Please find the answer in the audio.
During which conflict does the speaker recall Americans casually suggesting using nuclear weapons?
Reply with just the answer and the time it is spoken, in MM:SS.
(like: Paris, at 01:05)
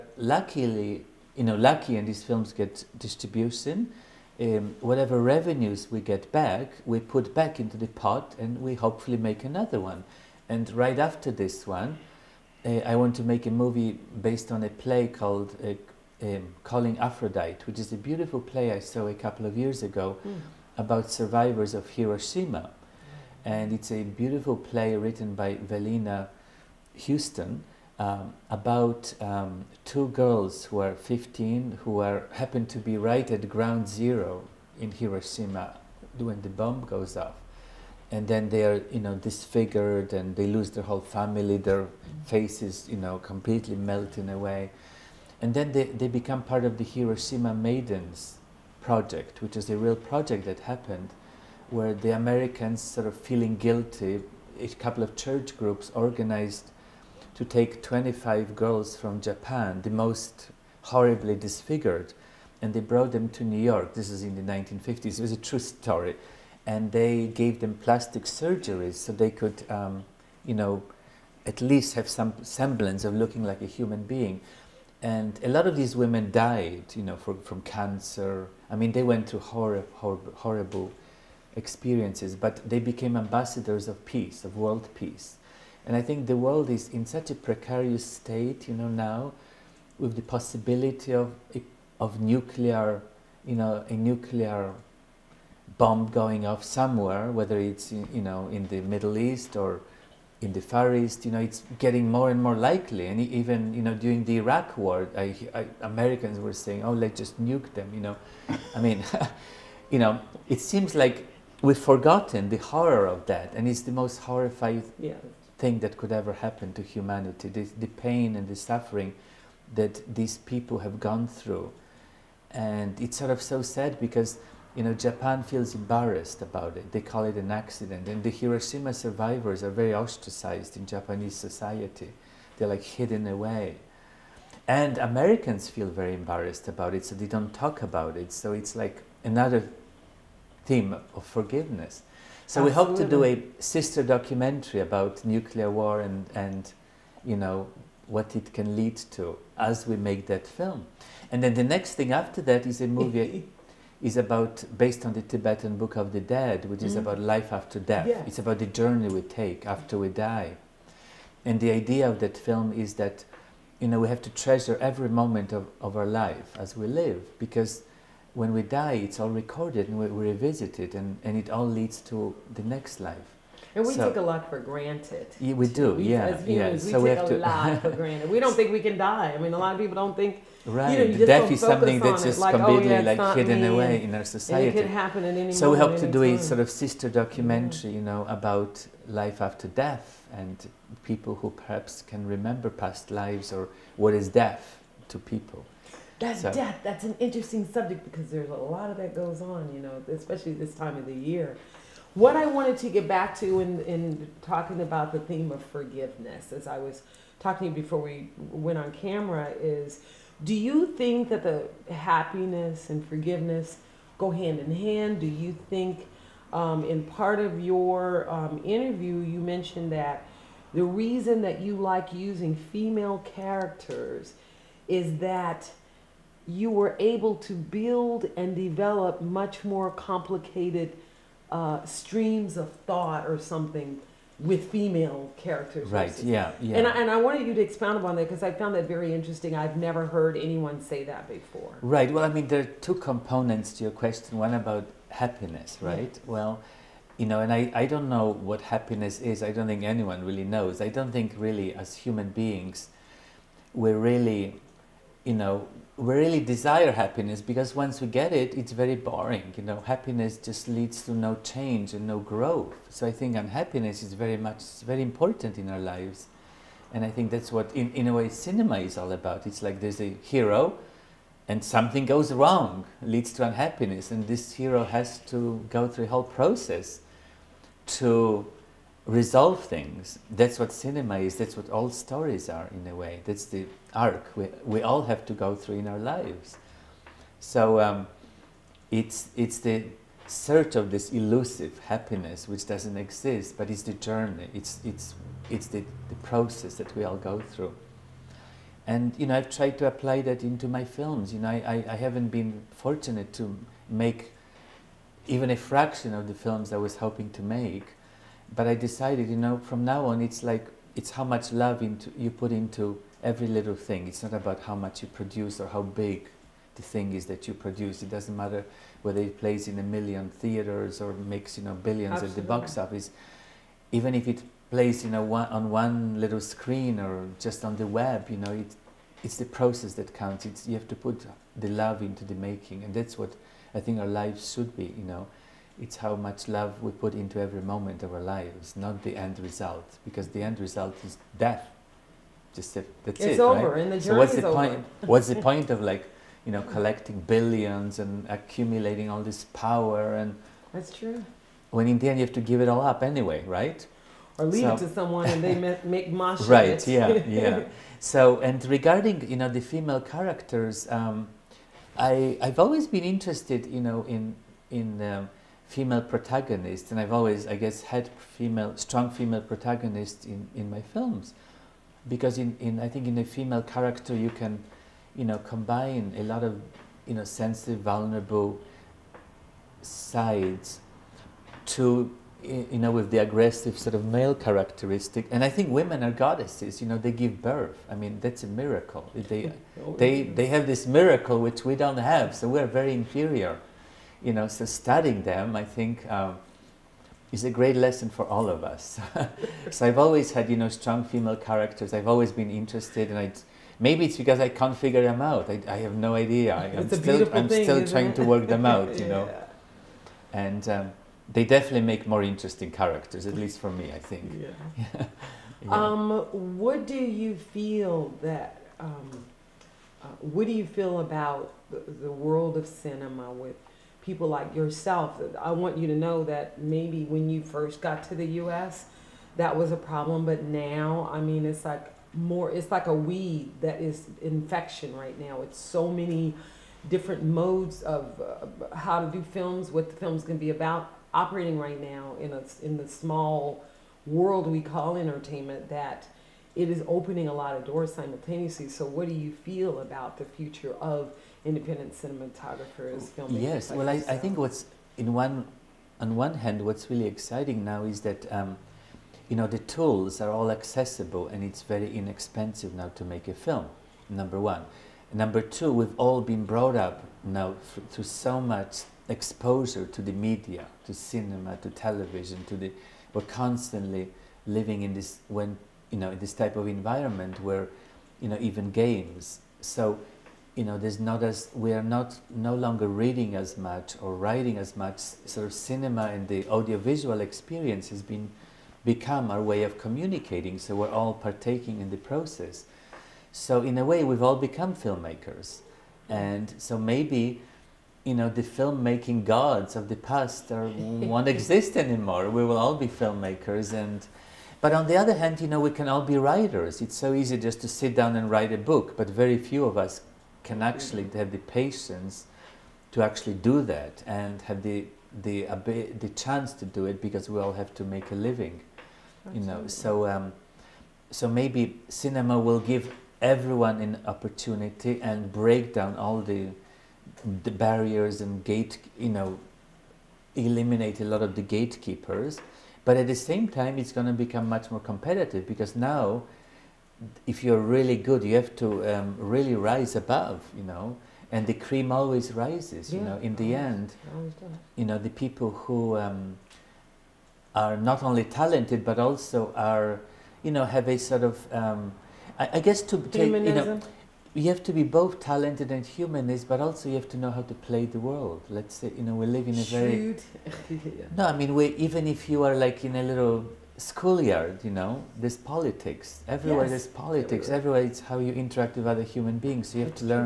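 Iraq war, at 01:44.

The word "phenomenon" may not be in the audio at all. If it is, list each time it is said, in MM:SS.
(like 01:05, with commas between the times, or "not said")
not said.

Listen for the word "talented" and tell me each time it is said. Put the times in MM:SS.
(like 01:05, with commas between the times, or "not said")
09:08, 09:15.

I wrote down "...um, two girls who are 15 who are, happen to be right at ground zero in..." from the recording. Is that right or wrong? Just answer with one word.
right.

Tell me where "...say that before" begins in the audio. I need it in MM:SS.
04:00.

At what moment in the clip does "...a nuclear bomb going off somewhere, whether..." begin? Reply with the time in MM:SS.
01:33.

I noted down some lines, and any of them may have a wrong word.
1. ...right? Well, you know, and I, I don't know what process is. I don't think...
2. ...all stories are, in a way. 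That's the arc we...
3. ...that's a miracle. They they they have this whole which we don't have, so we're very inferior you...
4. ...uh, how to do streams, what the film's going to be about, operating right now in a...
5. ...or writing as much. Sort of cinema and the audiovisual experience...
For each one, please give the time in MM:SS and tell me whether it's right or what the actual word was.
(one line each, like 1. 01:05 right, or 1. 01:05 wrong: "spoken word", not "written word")
1. 04:05 wrong: "happiness", not "process"
2. 04:41 right
3. 06:28 wrong: "miracle", not "whole"
4. 07:18 wrong: "films", not "streams"
5. 08:04 right.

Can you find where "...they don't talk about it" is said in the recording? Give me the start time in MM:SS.
02:17.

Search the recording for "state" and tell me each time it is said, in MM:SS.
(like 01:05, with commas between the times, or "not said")
01:28.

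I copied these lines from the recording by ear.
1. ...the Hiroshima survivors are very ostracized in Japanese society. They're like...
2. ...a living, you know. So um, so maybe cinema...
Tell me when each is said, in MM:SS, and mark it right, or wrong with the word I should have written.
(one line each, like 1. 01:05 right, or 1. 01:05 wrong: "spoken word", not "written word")
1. 02:08 right
2. 08:38 right.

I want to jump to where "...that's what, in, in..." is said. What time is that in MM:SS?
04:27.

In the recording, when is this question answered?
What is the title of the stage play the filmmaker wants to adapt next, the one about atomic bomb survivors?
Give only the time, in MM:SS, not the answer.
00:16.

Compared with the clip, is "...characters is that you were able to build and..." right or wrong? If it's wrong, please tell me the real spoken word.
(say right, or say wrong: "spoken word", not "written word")
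right.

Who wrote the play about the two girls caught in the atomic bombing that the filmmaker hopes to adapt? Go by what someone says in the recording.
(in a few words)
Velina Houston.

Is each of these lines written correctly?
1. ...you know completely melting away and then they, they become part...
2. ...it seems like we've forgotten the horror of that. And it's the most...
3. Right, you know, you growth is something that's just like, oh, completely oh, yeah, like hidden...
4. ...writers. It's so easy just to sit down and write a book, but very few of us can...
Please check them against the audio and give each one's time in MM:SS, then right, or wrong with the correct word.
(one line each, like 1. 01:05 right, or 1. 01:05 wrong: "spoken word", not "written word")
1. 00:42 right
2. 01:50 right
3. 03:00 wrong: "death", not "growth"
4. 08:26 right.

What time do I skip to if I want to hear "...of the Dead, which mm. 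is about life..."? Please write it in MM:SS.
02:35.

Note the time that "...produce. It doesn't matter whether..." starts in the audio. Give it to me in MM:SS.
05:17.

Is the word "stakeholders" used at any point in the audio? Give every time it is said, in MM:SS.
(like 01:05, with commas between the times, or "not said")
not said.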